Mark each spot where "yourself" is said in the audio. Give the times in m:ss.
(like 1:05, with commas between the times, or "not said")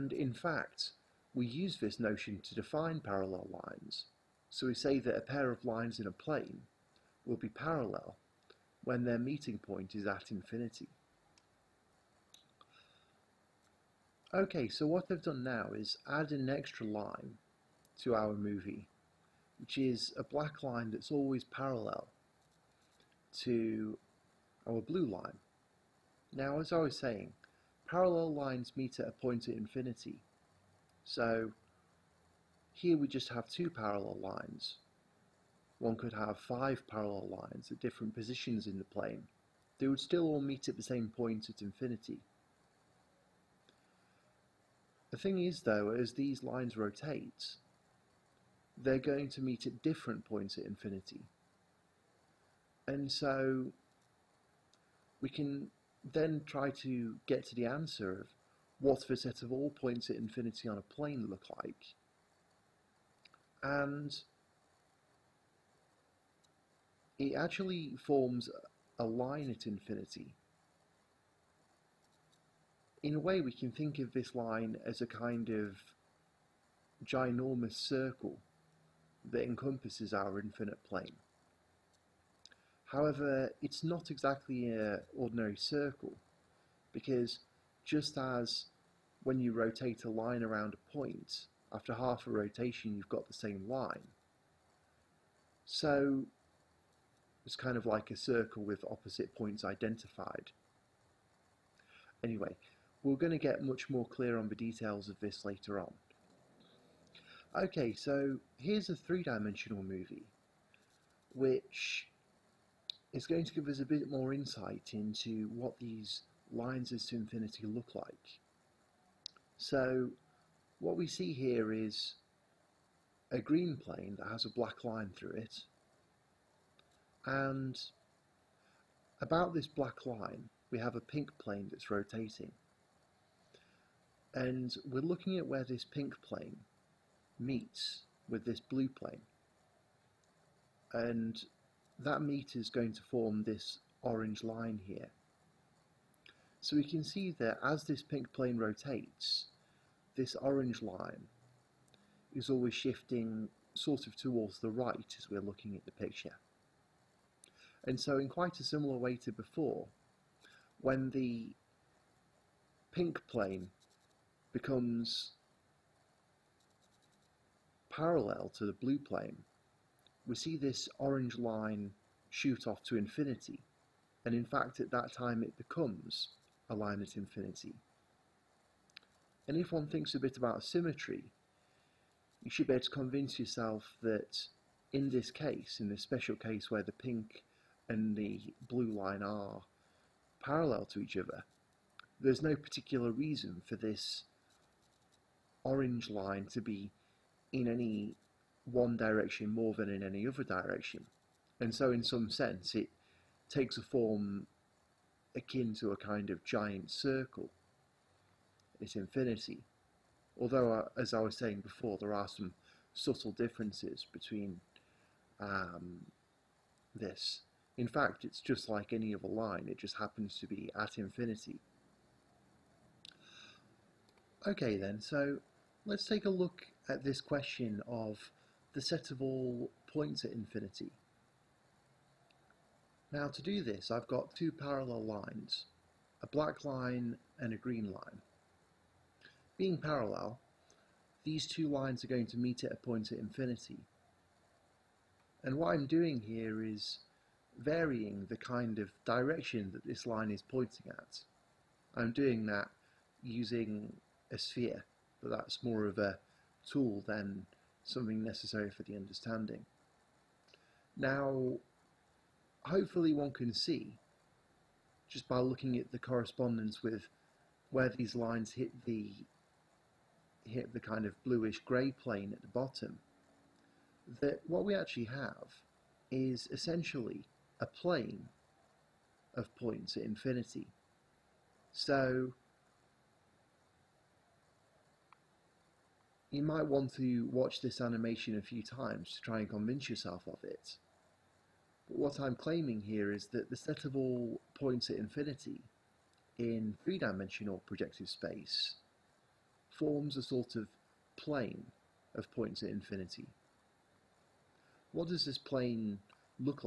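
3:03, 4:49.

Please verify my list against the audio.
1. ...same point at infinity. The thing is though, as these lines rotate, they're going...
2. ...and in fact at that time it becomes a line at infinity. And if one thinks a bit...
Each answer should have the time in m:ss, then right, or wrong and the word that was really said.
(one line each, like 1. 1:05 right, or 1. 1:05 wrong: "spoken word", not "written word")
1. 0:40 right
2. 2:54 right.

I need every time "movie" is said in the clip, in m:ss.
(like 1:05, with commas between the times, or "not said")
0:18, 1:49.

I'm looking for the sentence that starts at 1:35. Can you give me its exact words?
So it's kind of like a circle with opposite points identified.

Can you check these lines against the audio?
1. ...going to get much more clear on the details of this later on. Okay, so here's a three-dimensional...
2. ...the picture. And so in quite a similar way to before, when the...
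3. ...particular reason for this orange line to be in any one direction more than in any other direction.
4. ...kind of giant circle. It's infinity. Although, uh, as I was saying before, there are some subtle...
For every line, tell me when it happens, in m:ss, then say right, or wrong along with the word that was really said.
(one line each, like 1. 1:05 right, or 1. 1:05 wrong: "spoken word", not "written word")
1. 1:43 right
2. 2:35 right
3. 3:12 right
4. 3:25 right.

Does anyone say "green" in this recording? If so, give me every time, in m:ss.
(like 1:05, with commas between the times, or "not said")
2:03, 3:57.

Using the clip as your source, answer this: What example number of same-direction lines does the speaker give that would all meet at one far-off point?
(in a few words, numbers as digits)
5.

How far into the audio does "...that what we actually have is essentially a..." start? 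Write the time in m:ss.
4:34.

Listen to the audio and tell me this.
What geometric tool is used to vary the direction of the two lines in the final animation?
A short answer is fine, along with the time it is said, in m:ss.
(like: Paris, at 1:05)
a sphere, at 4:14.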